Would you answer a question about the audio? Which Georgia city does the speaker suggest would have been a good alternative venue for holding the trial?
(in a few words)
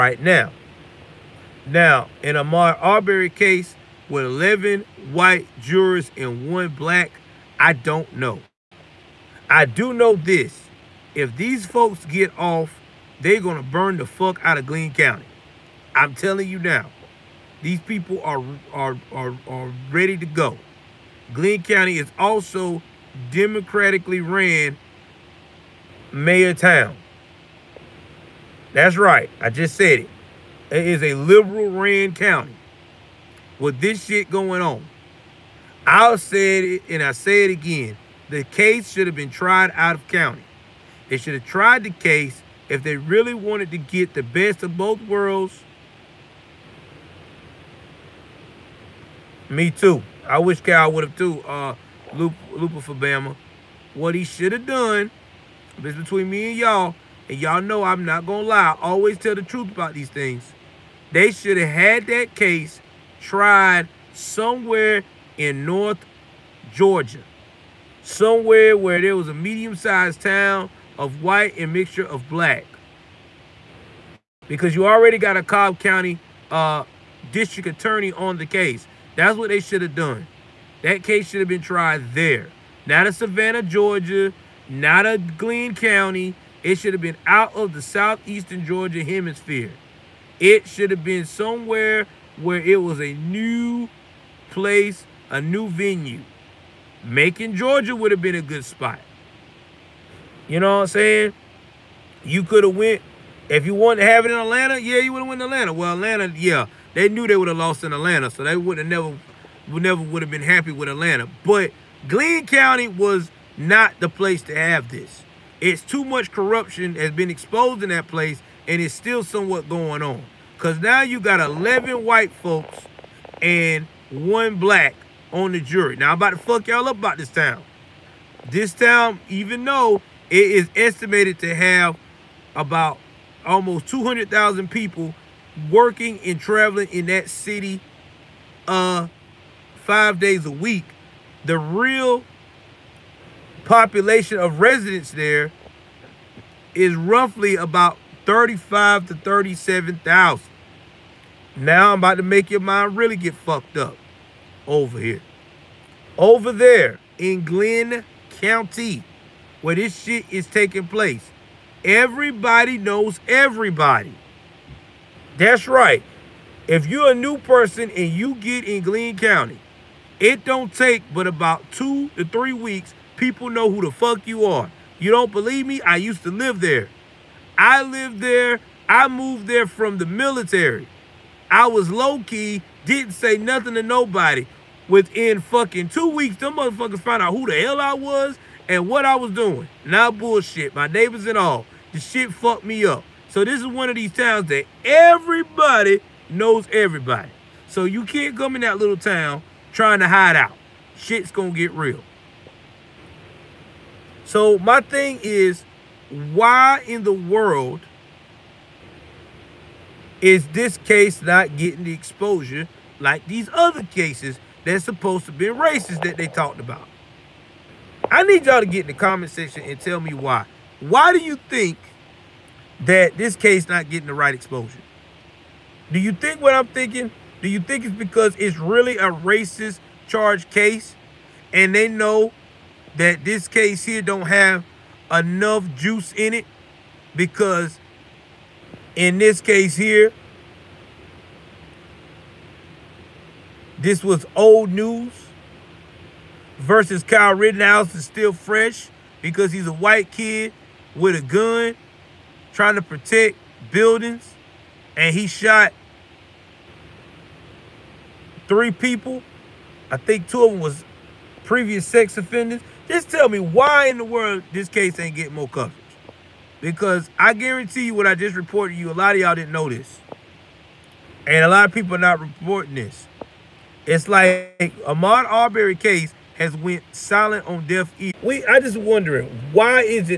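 Macon, Georgia.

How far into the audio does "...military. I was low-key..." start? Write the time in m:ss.
3:00.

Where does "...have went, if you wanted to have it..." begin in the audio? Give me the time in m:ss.
1:42.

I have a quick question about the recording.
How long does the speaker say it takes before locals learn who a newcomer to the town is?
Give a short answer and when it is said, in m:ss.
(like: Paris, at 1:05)
2 to 3 weeks, at 2:51.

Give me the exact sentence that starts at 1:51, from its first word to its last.
But Glynn County was not the place to have this.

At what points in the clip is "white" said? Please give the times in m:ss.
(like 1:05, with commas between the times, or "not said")
0:05, 1:11, 2:02, 4:09.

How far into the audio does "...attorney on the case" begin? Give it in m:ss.
1:17.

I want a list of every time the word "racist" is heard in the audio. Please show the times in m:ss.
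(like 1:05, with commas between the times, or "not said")
3:35, 3:49.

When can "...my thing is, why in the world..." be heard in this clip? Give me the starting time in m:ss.
3:24.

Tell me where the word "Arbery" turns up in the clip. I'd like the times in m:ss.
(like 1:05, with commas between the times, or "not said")
0:02, 4:35.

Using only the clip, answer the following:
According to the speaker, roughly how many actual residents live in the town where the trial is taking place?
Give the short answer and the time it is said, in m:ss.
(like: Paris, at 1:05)
35,000 to 37,000, at 2:28.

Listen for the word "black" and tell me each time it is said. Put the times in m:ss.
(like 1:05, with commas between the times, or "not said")
0:06, 1:12, 2:04.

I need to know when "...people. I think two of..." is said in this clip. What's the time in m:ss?
4:18.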